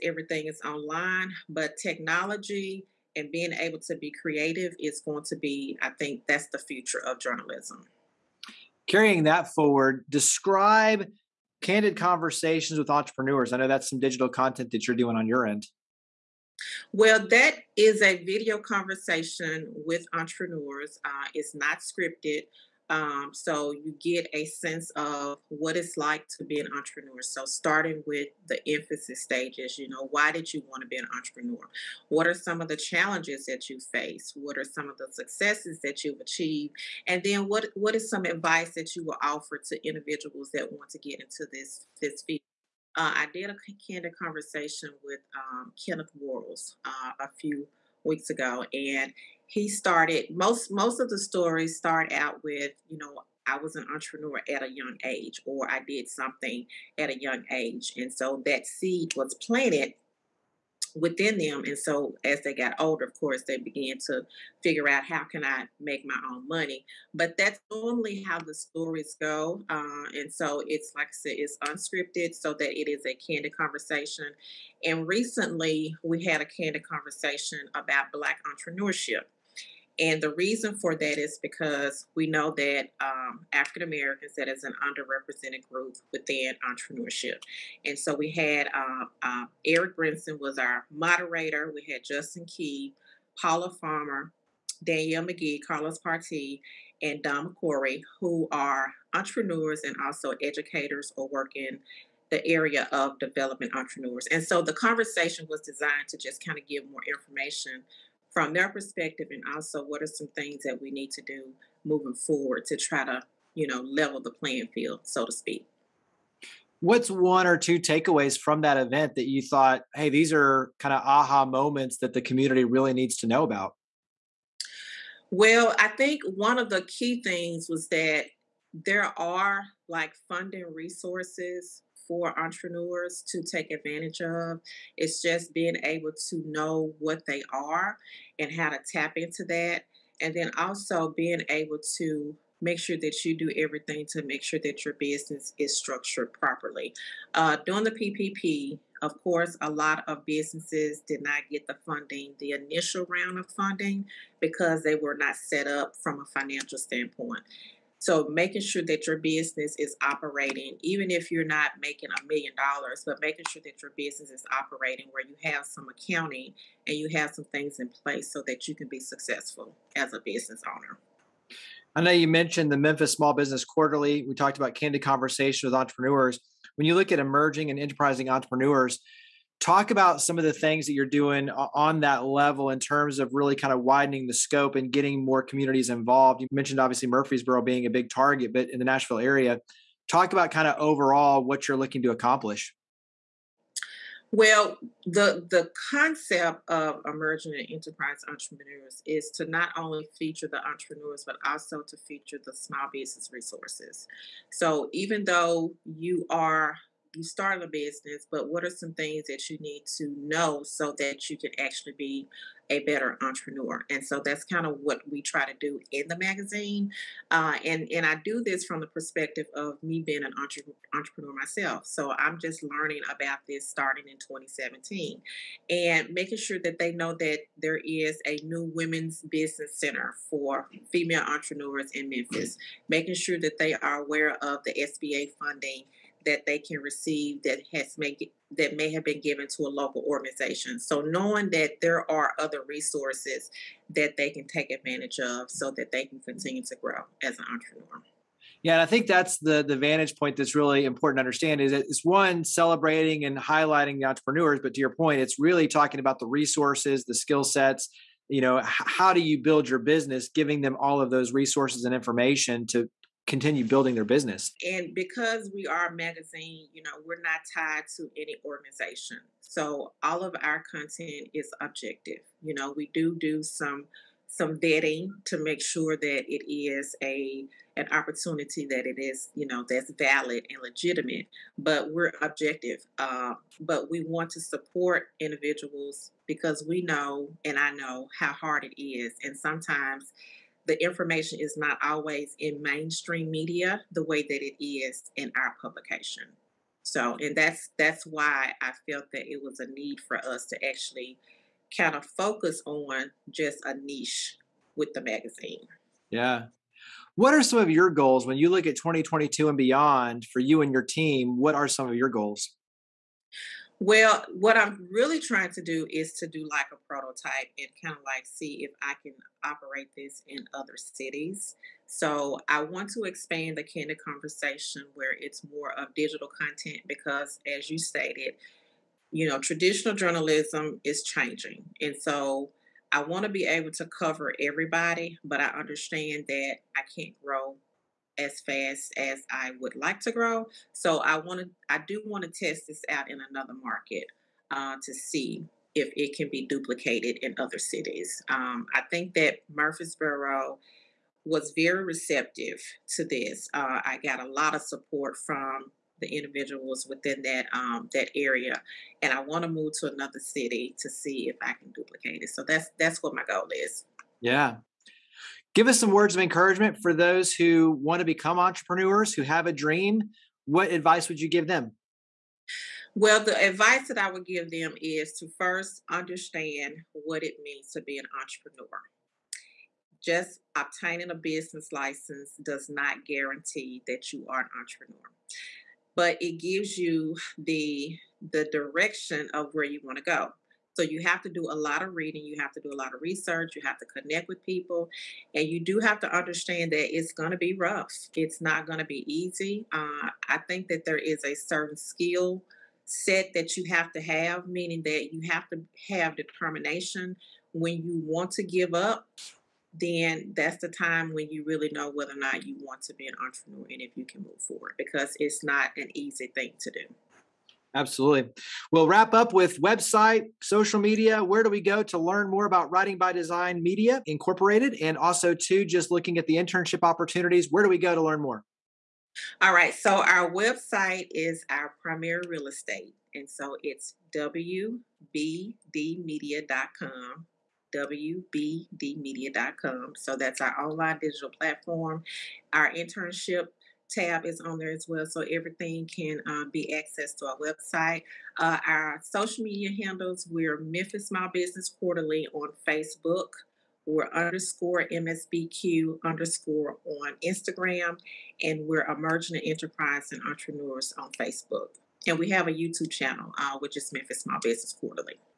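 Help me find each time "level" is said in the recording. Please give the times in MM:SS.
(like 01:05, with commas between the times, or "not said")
01:53, 03:02.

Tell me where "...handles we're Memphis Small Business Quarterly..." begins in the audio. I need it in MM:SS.
07:29.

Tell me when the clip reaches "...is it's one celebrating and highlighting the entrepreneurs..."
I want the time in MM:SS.
04:11.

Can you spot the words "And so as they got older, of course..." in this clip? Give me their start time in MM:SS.
01:01.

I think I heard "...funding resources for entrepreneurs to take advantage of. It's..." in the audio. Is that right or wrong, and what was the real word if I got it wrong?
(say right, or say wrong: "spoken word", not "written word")
right.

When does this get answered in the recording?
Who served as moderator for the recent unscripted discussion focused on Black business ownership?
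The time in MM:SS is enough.
01:29.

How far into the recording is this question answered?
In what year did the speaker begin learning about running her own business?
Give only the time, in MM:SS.
03:44.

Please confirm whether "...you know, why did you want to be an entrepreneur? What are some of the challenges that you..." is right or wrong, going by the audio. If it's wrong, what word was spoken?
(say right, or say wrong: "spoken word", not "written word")
right.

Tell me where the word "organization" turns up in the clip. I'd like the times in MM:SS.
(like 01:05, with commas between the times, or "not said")
04:00, 04:28.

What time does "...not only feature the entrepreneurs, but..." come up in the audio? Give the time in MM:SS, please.
03:19.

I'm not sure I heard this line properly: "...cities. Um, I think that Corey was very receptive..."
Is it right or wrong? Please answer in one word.
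wrong.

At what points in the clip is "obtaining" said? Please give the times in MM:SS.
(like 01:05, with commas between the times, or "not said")
06:20.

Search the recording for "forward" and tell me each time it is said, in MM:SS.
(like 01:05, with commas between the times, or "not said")
00:09, 01:52, 06:54.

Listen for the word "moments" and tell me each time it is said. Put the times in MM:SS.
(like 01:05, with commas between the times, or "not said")
02:01.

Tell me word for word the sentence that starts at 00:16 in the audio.
Well, that is a video conversation with entrepreneurs.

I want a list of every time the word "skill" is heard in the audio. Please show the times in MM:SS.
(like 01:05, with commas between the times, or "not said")
04:17, 06:41.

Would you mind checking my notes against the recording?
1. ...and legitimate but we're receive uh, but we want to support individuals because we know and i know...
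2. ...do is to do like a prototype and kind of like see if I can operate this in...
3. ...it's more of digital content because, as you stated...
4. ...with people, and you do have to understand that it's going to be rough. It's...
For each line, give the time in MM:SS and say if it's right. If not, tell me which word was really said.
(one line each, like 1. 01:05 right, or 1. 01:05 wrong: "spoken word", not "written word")
1. 04:40 wrong: "objective", not "receive"
2. 05:15 right
3. 05:25 right
4. 06:34 right.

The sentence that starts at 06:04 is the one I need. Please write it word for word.
Yeah, Give us some words of encouragement for those who want to become entrepreneurs, who have a dream.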